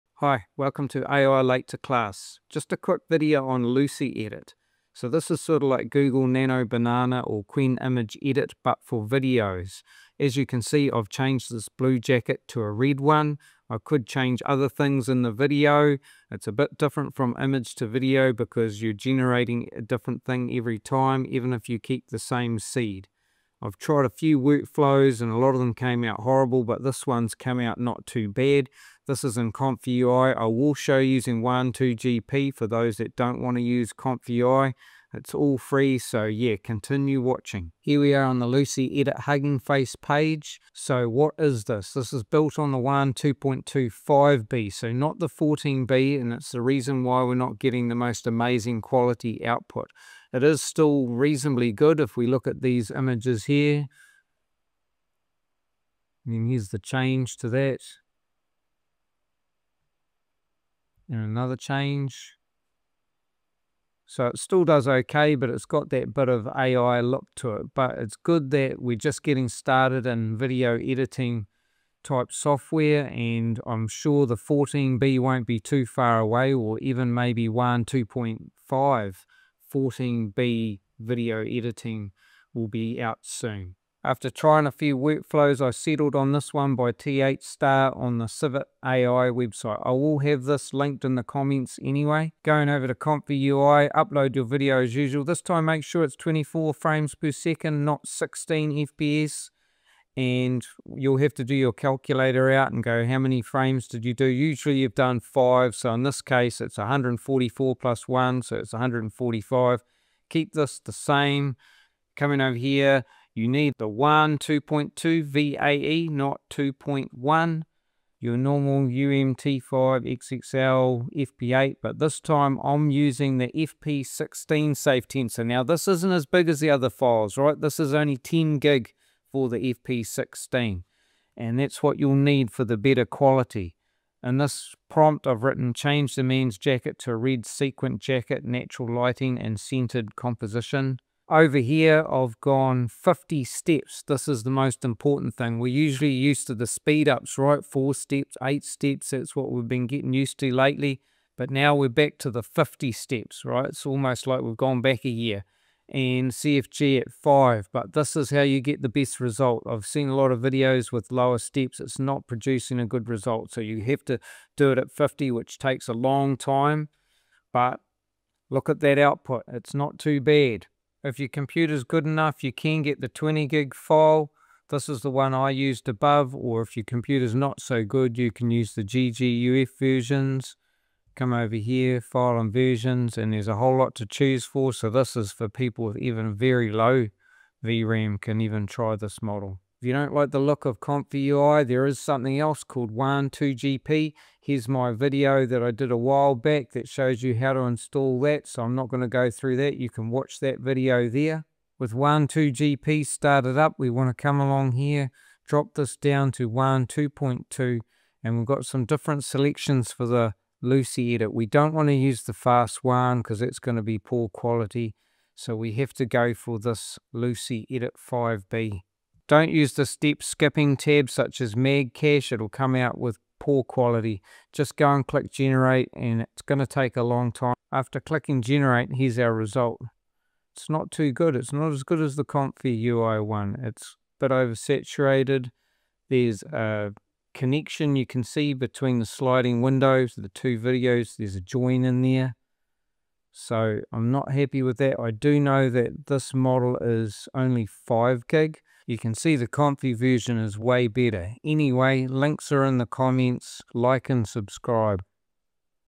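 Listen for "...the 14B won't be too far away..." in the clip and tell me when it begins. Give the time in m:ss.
1:14.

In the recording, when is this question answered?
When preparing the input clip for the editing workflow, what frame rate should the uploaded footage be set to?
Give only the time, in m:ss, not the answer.
1:36.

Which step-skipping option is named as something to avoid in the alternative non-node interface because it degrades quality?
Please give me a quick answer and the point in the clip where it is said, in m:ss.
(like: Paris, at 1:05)
MagCache, at 3:41.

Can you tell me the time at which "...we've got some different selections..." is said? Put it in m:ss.
3:28.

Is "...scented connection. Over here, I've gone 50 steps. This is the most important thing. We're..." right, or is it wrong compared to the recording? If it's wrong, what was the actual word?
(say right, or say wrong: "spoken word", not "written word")
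wrong: "composition", not "connection".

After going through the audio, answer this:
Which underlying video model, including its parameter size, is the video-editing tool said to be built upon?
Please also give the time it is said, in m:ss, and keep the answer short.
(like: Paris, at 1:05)
Wan 2.2 5B, at 0:42.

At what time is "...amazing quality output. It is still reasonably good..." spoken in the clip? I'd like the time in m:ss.
0:48.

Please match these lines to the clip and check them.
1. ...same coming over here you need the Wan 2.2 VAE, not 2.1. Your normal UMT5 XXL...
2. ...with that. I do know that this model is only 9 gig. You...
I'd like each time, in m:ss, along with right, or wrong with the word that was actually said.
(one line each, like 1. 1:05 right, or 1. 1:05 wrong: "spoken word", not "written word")
1. 1:50 right
2. 4:04 wrong: "5", not "9".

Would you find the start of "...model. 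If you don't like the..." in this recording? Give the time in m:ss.
3:09.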